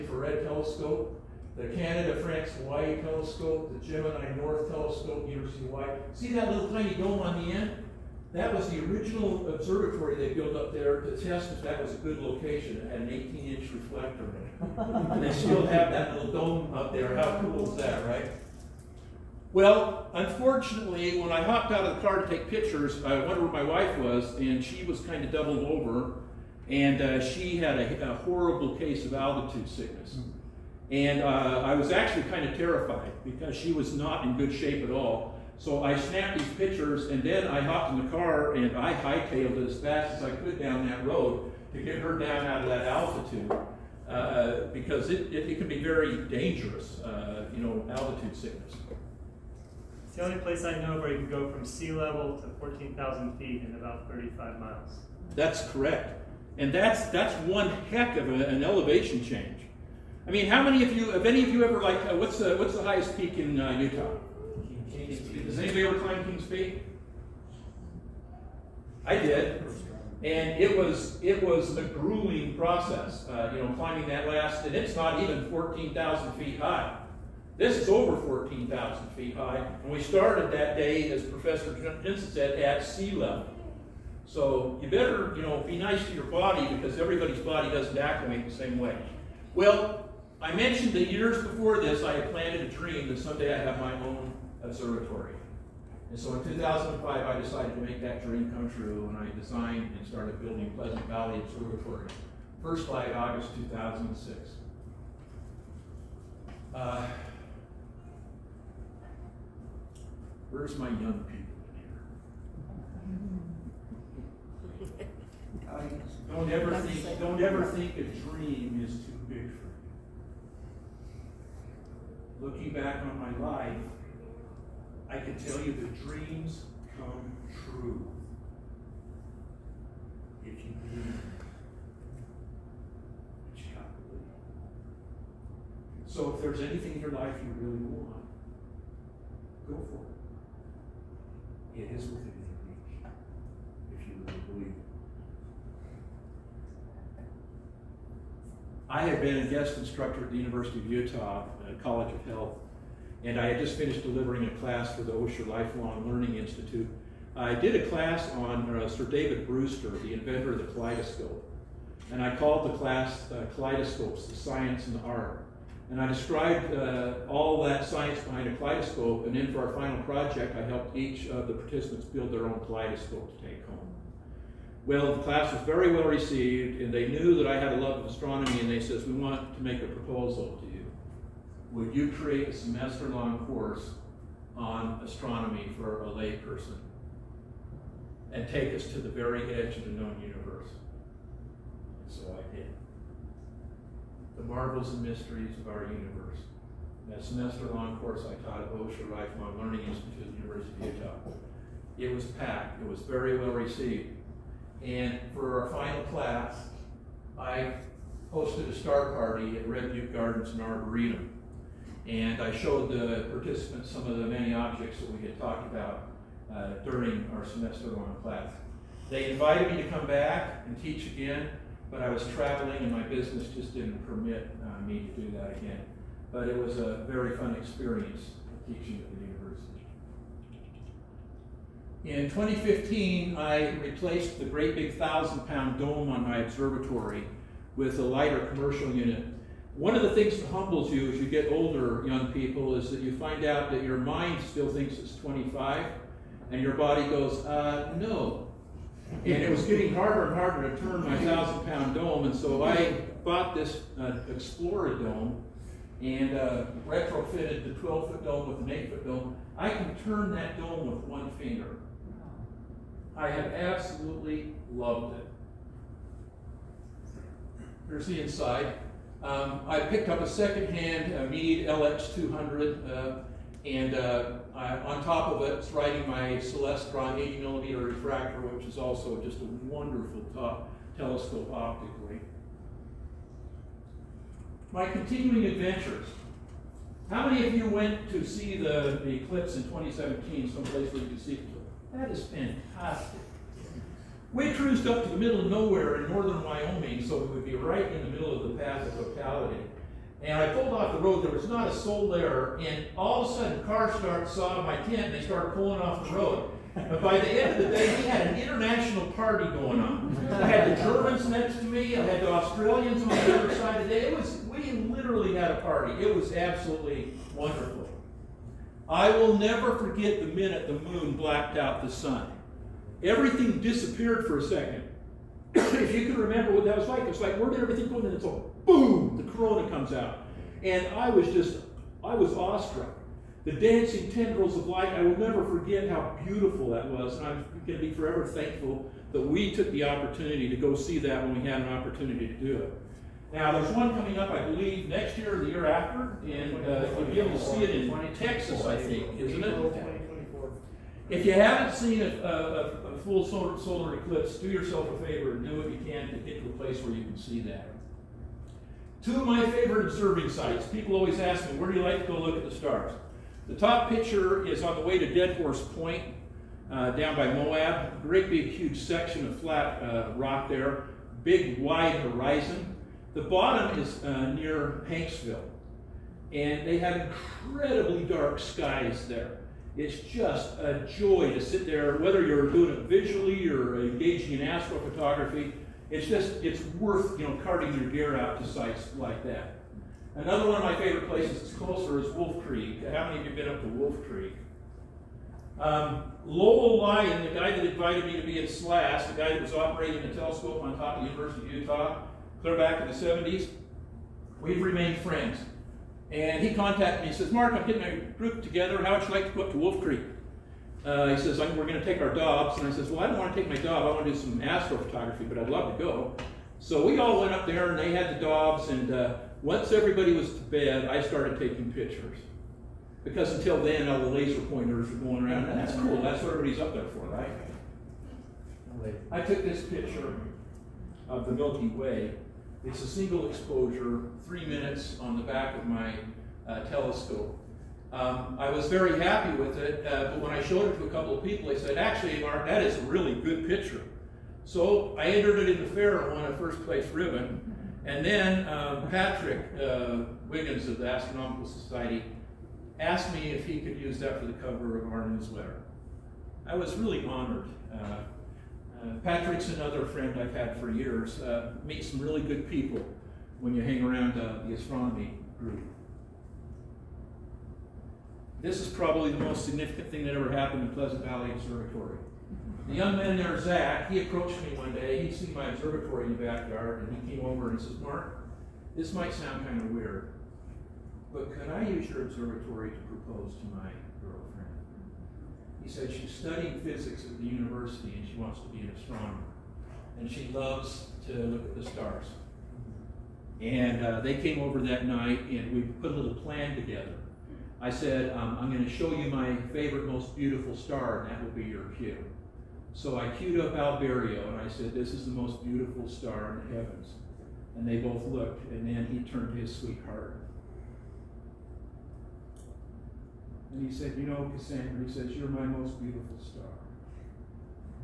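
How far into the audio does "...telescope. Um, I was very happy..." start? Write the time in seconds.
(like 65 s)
436 s.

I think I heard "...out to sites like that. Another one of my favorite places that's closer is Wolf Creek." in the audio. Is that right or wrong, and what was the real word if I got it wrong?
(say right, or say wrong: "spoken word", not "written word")
right.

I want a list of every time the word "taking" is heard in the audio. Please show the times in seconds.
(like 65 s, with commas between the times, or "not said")
421 s.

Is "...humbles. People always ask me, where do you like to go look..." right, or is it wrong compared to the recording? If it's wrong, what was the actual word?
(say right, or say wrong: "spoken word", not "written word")
wrong: "sites", not "humbles".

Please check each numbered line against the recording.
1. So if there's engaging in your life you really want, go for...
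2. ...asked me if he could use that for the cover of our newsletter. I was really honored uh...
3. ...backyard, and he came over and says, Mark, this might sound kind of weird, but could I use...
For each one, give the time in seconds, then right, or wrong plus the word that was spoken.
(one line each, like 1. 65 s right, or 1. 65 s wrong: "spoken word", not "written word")
1. 136 s wrong: "anything", not "engaging"
2. 452 s right
3. 476 s right.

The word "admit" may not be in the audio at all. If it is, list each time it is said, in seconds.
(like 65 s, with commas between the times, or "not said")
not said.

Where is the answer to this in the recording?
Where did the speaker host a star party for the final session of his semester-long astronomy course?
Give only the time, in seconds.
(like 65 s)
209 s.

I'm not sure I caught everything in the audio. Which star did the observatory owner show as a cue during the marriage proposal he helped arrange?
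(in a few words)
Albireo.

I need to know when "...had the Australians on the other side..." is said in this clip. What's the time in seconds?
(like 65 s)
312 s.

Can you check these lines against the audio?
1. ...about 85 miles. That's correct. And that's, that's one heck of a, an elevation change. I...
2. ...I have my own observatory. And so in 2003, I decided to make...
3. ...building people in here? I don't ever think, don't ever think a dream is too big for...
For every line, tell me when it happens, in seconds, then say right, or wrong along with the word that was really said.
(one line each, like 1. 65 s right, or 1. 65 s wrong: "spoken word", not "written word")
1. 53 s wrong: "35", not "85"
2. 93 s wrong: "2005", not "2003"
3. 110 s wrong: "young", not "building".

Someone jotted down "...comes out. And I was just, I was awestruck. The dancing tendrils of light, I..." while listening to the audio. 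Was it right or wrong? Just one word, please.
right.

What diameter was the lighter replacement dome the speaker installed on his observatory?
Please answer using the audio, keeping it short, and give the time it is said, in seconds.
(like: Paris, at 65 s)
8 foot, at 258 s.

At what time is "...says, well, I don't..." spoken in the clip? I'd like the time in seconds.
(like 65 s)
412 s.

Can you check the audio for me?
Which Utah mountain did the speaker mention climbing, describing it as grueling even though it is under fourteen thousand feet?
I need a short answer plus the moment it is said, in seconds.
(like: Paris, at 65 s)
King's Peak, at 66 s.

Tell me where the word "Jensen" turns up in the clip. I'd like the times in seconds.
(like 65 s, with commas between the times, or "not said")
82 s.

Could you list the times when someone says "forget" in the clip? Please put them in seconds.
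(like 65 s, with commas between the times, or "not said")
319 s, 335 s.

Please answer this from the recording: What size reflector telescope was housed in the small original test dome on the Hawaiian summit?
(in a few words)
18 inch.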